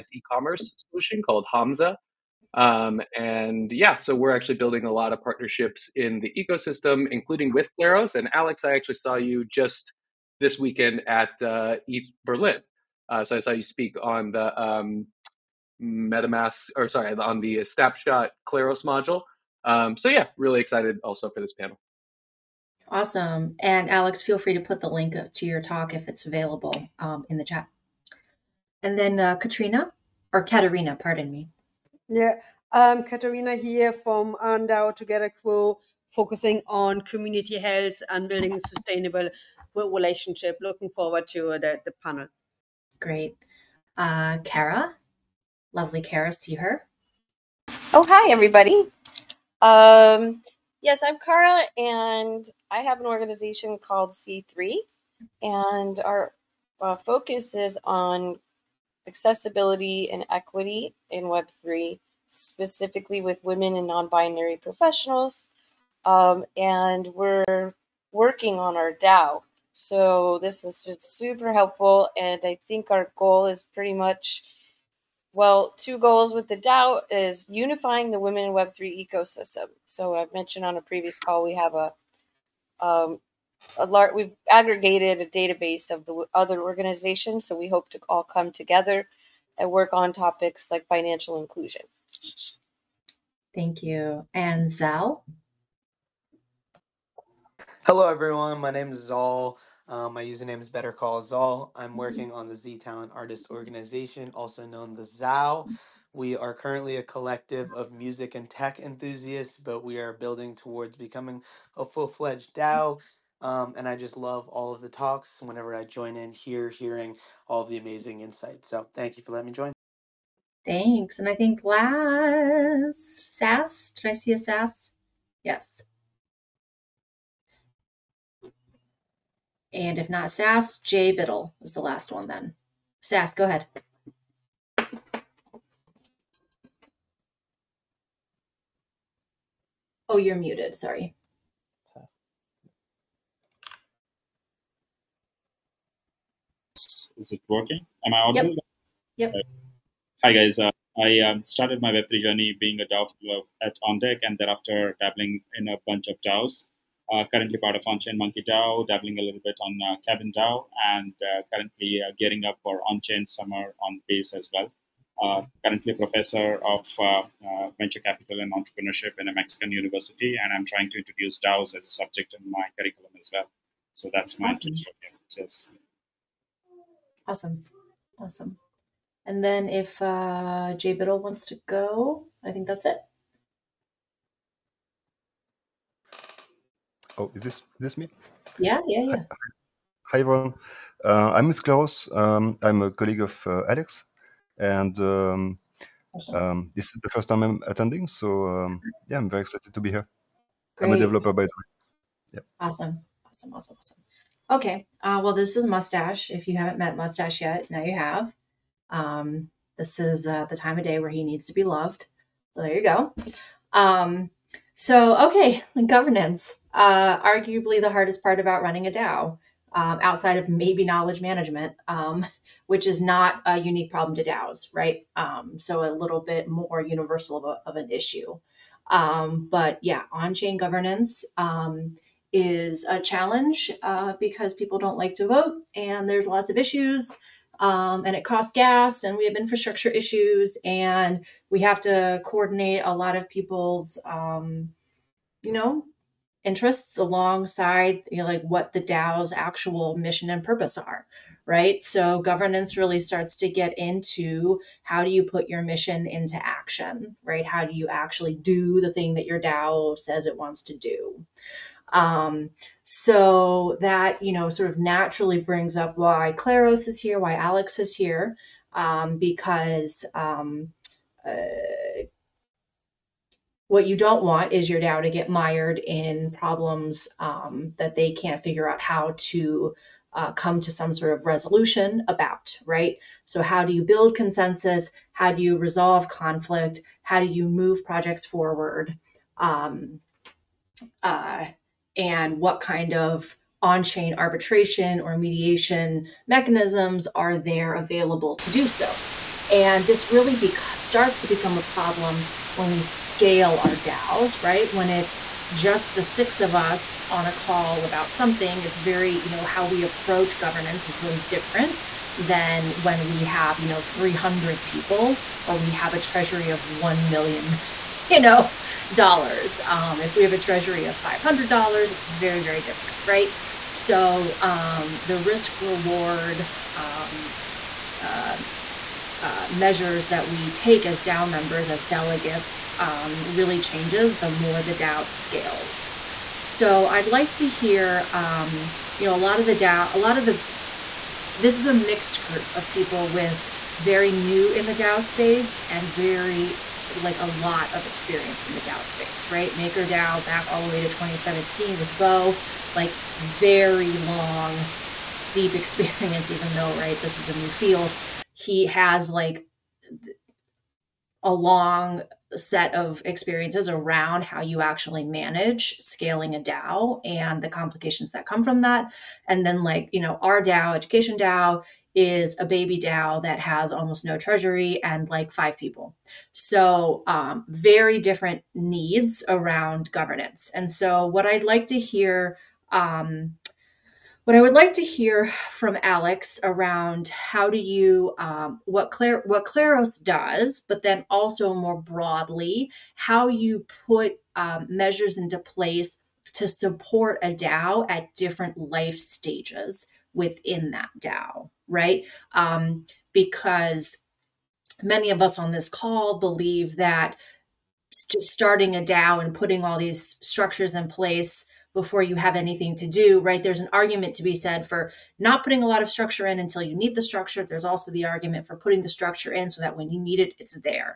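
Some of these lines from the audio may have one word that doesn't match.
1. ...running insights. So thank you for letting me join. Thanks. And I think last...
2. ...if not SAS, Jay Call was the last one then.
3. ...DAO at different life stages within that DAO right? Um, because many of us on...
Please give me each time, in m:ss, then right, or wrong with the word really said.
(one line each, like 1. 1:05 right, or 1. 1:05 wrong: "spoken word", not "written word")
1. 1:57 wrong: "amazing", not "running"
2. 2:09 wrong: "Biddle", not "Call"
3. 6:37 right.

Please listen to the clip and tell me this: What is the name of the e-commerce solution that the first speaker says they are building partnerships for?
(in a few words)
Hamza.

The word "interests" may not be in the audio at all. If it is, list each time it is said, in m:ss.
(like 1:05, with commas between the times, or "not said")
4:06.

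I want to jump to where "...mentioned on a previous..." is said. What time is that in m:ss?
1:20.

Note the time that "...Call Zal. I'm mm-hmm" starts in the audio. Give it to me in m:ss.
1:40.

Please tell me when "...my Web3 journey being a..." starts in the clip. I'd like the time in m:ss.
2:31.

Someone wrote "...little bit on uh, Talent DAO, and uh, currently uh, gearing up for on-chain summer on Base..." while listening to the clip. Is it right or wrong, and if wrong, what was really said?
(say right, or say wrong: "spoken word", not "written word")
wrong: "Cabin", not "Talent".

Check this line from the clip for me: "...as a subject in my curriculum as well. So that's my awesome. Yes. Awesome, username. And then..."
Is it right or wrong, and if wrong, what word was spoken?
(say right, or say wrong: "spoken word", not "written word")
wrong: "awesome", not "username".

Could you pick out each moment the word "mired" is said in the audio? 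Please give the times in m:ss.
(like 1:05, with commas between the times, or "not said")
4:35.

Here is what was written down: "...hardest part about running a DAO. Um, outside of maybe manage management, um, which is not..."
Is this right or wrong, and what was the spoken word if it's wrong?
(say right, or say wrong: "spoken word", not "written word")
wrong: "knowledge", not "manage".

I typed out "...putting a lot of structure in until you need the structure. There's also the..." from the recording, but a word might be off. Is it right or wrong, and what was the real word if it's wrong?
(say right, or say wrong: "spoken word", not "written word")
right.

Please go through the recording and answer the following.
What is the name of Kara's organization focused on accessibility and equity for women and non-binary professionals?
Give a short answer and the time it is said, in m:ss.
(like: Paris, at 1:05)
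C3, at 0:54.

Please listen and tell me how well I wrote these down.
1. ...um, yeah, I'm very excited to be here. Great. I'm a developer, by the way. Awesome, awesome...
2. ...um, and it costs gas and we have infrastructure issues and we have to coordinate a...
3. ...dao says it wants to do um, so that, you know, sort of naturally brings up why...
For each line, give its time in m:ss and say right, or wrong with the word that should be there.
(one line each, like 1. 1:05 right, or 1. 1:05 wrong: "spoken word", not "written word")
1. 3:18 right
2. 3:57 right
3. 4:19 right.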